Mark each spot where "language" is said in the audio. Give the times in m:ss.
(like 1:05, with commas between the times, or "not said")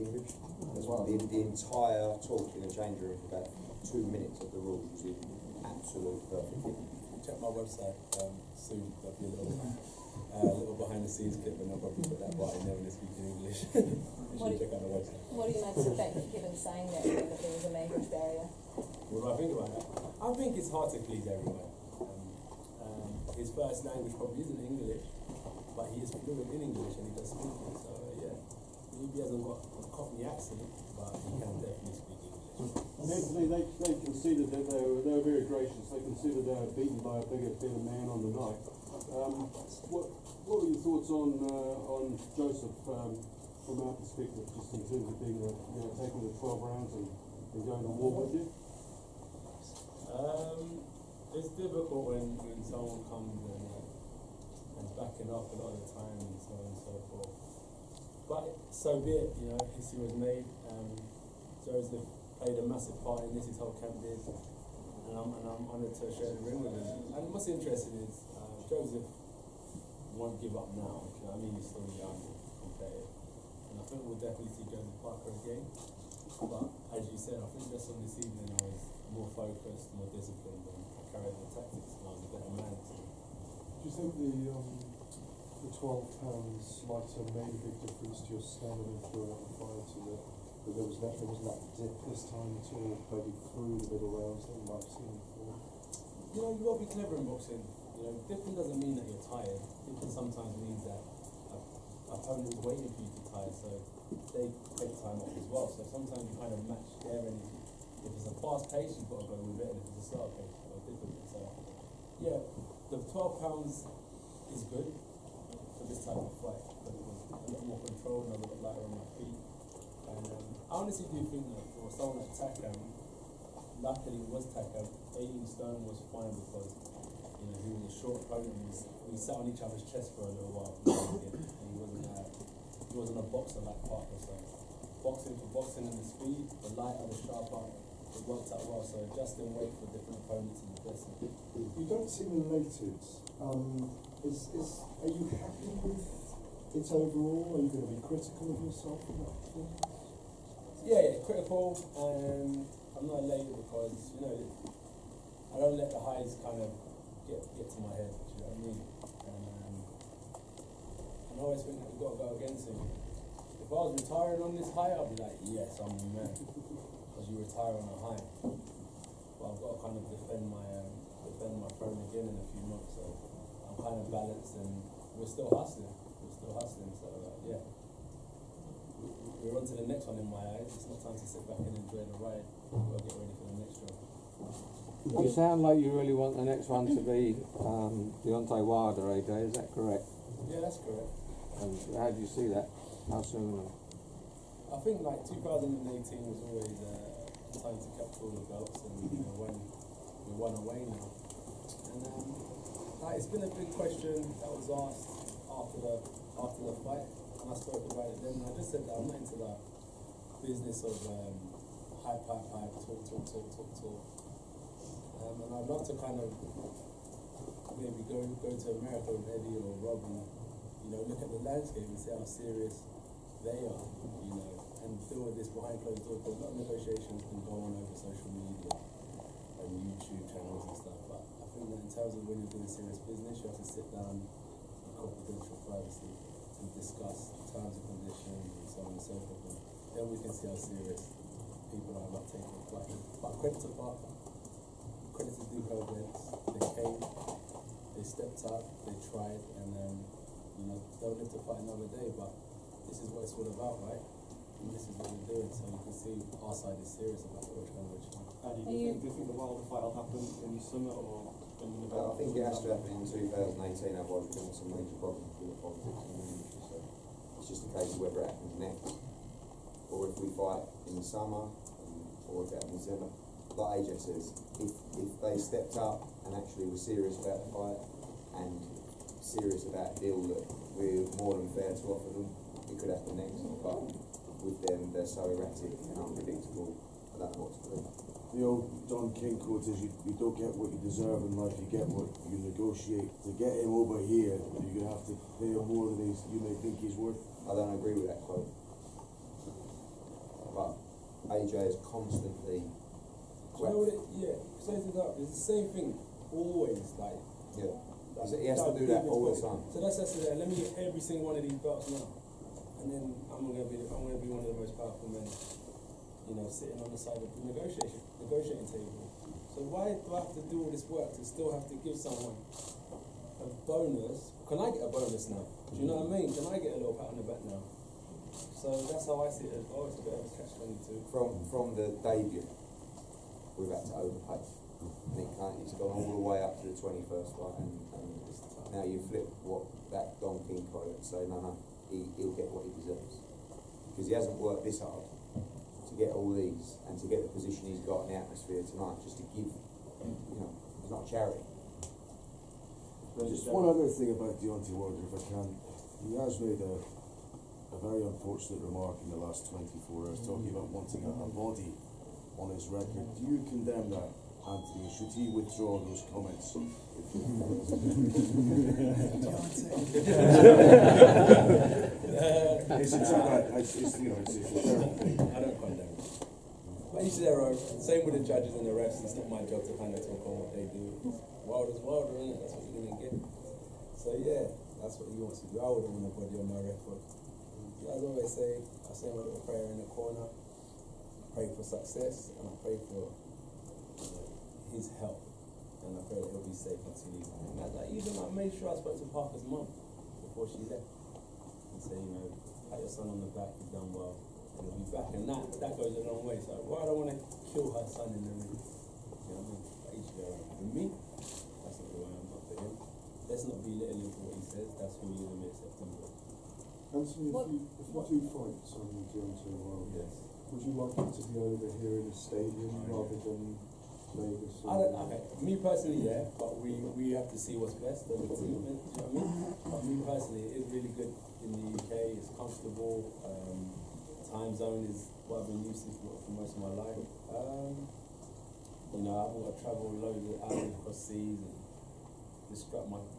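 0:17, 0:23.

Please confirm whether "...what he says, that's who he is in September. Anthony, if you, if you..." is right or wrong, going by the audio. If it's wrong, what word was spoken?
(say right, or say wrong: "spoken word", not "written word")
right.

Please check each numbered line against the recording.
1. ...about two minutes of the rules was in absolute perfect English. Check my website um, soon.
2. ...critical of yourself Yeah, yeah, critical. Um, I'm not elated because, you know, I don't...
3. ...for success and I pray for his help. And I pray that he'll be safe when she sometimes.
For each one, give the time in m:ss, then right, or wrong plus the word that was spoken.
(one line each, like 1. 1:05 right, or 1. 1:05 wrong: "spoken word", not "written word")
1. 0:03 right
2. 2:28 right
3. 6:31 wrong: "leaves", not "sometimes".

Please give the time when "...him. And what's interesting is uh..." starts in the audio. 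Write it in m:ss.
1:06.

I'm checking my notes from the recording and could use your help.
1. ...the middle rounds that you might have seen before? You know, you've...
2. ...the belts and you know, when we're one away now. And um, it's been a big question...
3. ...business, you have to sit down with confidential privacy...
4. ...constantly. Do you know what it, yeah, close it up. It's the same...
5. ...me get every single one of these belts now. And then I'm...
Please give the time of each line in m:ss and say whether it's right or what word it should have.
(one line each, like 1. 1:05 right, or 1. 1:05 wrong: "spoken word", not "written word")
1. 1:33 right
2. 3:18 right
3. 3:53 right
4. 5:01 right
5. 5:10 right.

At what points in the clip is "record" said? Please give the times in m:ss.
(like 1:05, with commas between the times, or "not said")
6:02, 6:26.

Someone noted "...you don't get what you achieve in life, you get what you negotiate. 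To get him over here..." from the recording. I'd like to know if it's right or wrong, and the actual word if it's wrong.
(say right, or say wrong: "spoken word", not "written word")
wrong: "deserve", not "achieve".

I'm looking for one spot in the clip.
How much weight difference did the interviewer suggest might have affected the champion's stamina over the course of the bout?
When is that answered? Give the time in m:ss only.
1:25.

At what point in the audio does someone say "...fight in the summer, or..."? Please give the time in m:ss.
4:30.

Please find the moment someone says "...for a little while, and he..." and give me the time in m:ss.
2:10.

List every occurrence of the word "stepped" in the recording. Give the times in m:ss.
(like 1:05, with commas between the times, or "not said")
4:08, 4:35.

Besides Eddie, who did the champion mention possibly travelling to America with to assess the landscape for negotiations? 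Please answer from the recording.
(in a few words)
Robbie.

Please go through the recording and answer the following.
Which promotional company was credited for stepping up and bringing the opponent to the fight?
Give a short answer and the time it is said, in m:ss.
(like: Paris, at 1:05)
Duco Events, at 4:05.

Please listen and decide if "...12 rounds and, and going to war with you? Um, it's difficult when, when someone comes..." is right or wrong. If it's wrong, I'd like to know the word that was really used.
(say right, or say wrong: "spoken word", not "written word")
right.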